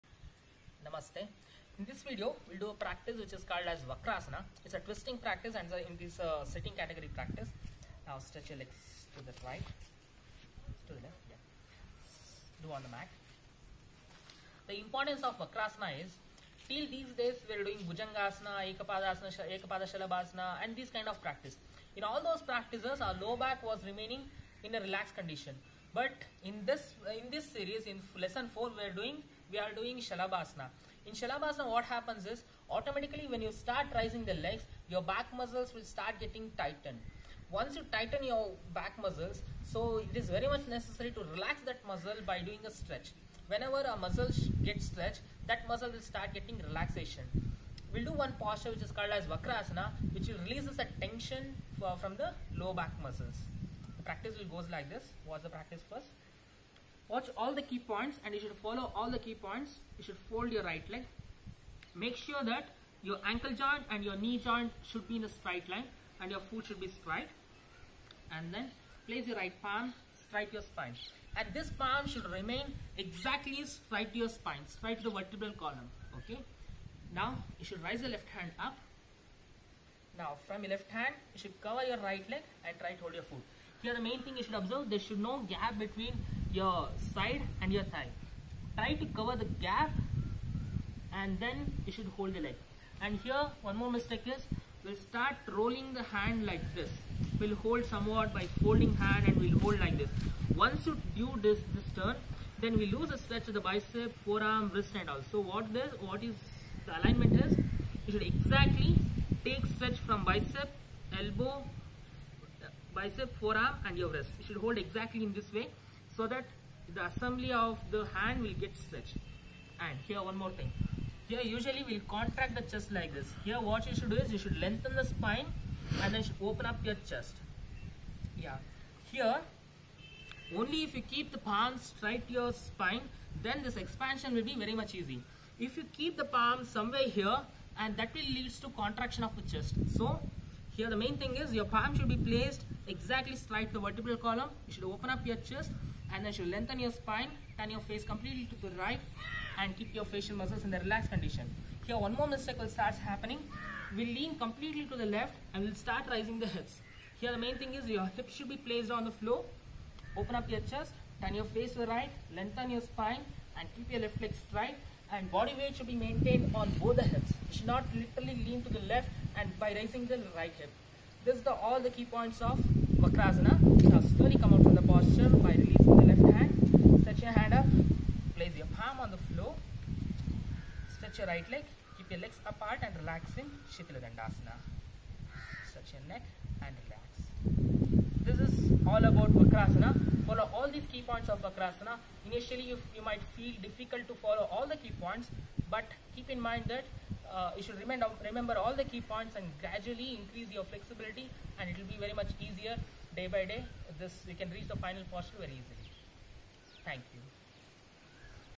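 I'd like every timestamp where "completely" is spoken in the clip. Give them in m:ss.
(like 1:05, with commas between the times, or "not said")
2:28, 2:34.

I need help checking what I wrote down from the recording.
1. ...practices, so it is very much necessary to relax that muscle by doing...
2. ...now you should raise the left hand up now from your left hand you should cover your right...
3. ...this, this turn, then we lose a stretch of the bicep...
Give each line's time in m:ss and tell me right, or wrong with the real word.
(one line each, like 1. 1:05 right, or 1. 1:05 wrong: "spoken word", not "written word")
1. 0:39 wrong: "muscles", not "practices"
2. 1:17 right
3. 1:41 right.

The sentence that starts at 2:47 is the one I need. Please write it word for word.
You should not literally lean to the left and by raising the right hip.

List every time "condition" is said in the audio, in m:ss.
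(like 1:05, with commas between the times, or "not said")
0:25, 2:31.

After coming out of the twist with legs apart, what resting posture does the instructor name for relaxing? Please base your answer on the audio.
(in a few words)
Shitala Dandasana.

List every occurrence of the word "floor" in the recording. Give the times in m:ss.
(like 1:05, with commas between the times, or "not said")
2:39, 2:59.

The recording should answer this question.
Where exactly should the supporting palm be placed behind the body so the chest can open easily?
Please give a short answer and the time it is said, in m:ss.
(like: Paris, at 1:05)
straight to the vertebral column, at 2:22.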